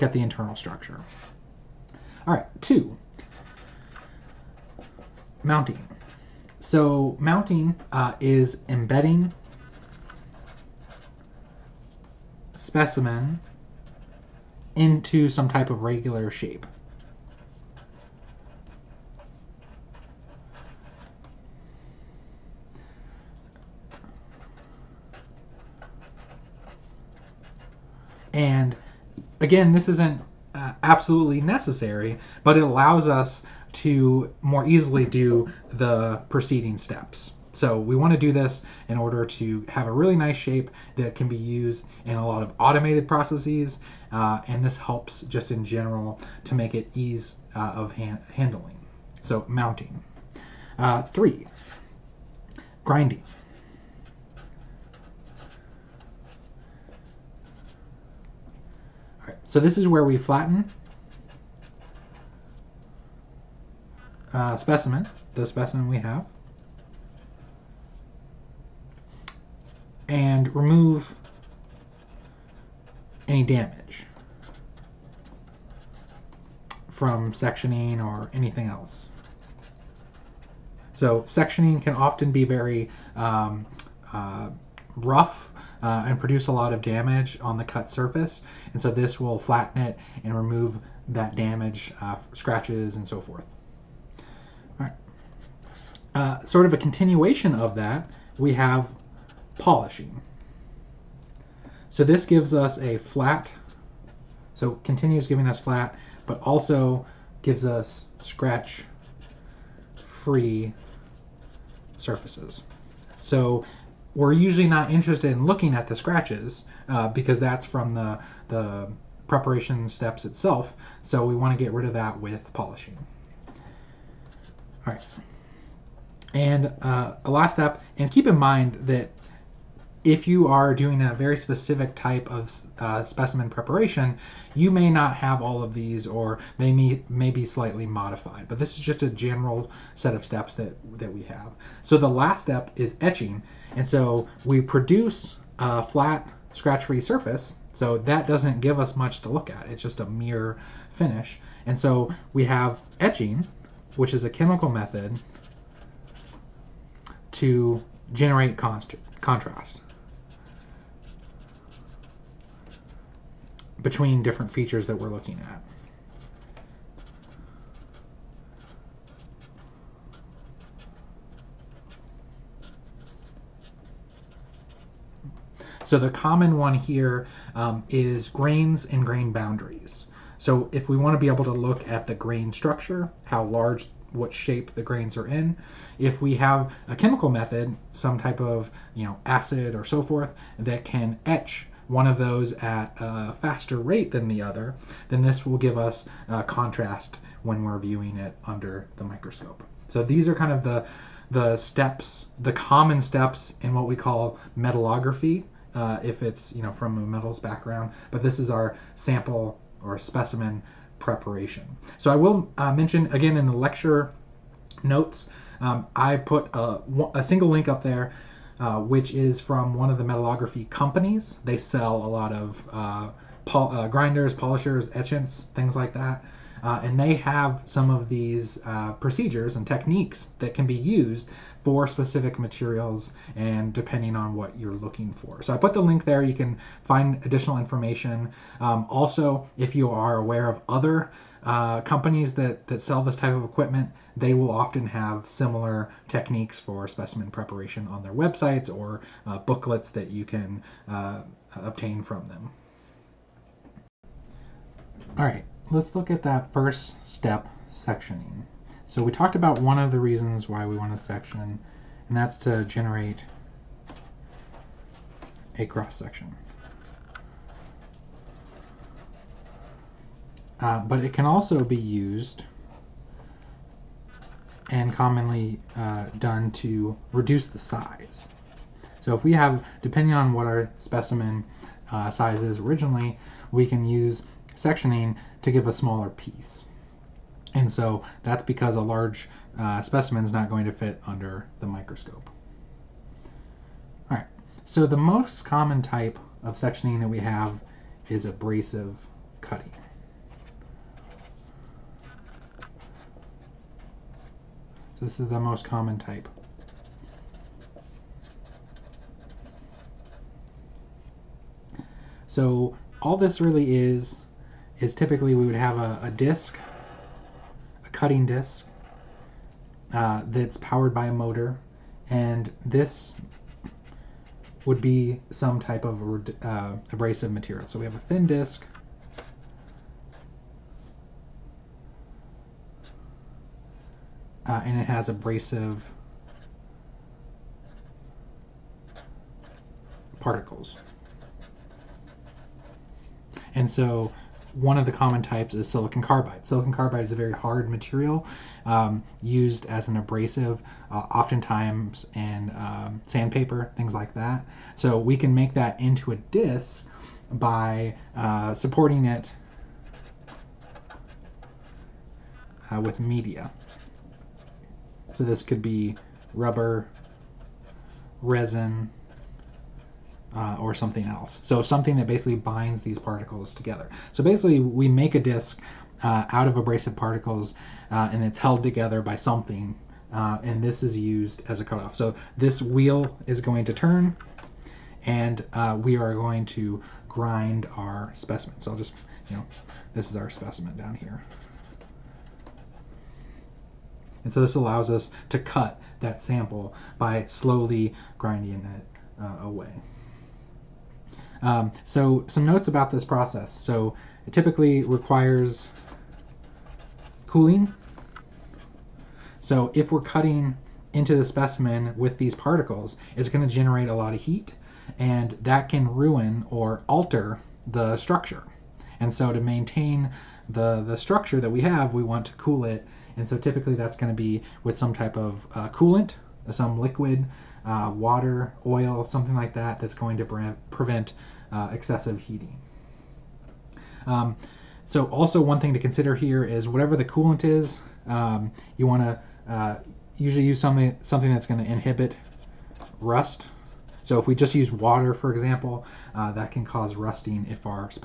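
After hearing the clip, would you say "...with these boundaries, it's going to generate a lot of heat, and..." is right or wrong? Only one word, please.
wrong.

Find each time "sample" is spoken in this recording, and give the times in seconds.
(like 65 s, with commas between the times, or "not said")
208 s, 396 s.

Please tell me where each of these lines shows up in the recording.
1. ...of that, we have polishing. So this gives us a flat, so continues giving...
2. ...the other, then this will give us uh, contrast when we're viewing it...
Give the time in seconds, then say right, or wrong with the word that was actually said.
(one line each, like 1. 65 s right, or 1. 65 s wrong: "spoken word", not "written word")
1. 97 s right
2. 194 s right.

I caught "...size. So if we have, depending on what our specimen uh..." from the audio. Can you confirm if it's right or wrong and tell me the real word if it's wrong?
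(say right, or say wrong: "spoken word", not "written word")
right.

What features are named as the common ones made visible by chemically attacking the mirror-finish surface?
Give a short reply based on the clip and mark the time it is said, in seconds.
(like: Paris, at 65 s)
Grains and grain boundaries, at 178 s.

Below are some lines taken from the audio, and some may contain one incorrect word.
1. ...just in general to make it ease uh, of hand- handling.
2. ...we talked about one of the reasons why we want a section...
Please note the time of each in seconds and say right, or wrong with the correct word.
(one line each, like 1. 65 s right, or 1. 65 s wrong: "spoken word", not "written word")
1. 45 s right
2. 259 s right.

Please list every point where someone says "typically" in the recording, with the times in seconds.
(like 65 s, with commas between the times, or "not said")
314 s, 404 s, 423 s.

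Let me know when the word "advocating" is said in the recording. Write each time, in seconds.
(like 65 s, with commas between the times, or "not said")
not said.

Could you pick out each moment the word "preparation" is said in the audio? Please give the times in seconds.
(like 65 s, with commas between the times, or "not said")
119 s, 133 s, 210 s, 247 s.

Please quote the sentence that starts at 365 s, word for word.
So this could be rubber, resin, uh, or something else.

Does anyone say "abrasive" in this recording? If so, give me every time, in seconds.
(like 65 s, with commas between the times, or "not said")
298 s, 326 s, 335 s, 349 s, 376 s.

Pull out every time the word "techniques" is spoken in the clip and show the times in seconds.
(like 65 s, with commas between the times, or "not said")
229 s, 246 s.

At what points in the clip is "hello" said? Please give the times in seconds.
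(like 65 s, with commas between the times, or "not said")
not said.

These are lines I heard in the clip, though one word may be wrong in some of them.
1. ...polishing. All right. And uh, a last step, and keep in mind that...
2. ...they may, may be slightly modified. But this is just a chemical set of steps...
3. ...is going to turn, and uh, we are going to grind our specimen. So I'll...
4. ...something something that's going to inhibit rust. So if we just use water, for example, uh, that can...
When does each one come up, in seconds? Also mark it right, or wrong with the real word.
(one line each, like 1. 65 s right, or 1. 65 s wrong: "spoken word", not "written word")
1. 122 s right
2. 136 s wrong: "general", not "chemical"
3. 383 s right
4. 440 s right.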